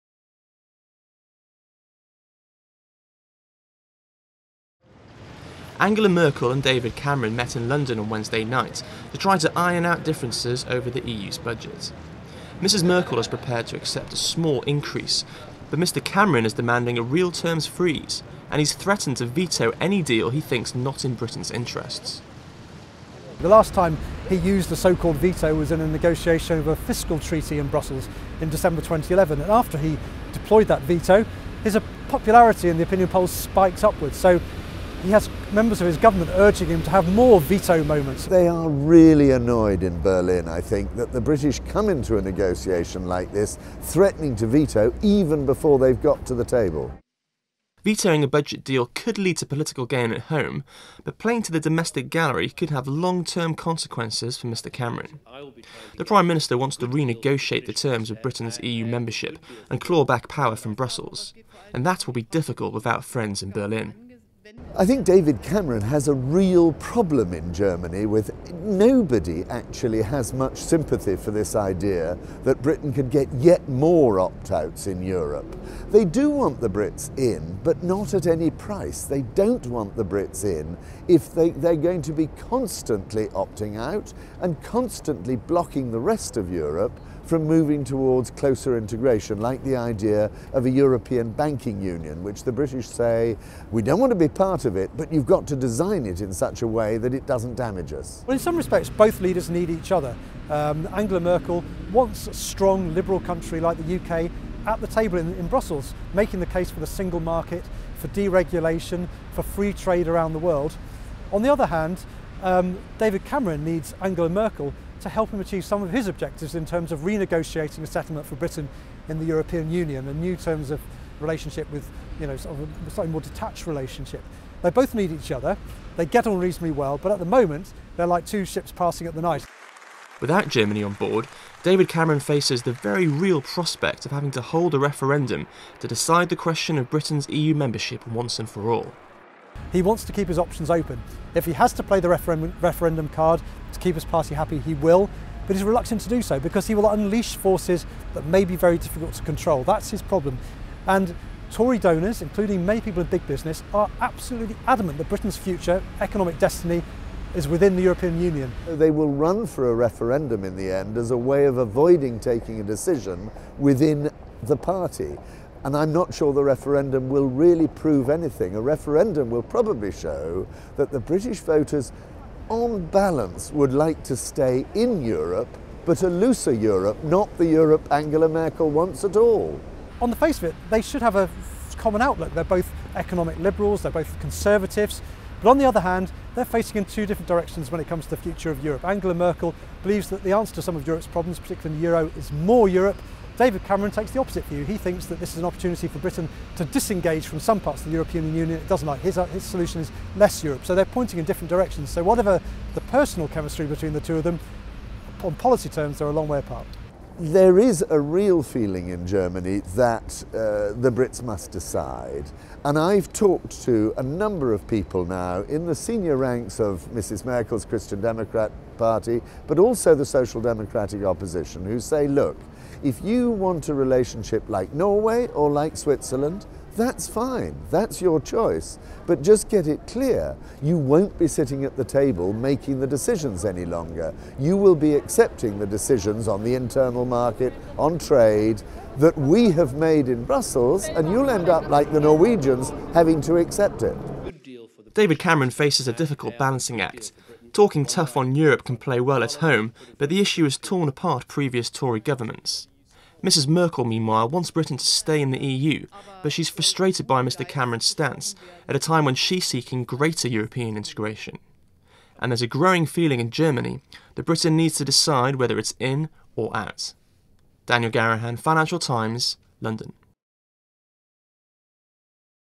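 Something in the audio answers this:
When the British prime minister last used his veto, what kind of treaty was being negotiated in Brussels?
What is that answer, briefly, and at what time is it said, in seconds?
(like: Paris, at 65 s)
fiscal treaty, at 26 s.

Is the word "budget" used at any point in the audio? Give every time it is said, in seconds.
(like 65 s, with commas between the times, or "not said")
11 s, 48 s.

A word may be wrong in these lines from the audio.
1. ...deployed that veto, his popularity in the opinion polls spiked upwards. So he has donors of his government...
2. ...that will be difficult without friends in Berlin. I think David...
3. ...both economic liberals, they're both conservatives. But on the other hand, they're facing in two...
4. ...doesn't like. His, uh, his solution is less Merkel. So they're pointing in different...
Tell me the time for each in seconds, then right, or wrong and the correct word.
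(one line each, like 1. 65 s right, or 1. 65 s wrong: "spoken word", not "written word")
1. 30 s wrong: "members", not "donors"
2. 61 s right
3. 182 s right
4. 198 s wrong: "Europe", not "Merkel".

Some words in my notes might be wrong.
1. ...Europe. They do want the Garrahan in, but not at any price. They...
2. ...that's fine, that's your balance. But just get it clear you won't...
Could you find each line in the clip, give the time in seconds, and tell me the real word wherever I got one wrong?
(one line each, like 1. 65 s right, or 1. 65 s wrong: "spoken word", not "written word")
1. 75 s wrong: "Brits", not "Garrahan"
2. 226 s wrong: "choice", not "balance".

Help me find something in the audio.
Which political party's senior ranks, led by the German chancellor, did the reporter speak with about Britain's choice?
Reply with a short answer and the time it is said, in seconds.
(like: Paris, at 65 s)
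Christian Democrat Party, at 217 s.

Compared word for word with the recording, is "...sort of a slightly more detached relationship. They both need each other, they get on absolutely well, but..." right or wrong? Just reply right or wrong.
wrong.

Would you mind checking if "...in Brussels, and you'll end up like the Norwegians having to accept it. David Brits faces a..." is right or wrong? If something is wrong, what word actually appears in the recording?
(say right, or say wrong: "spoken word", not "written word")
wrong: "Cameron", not "Brits".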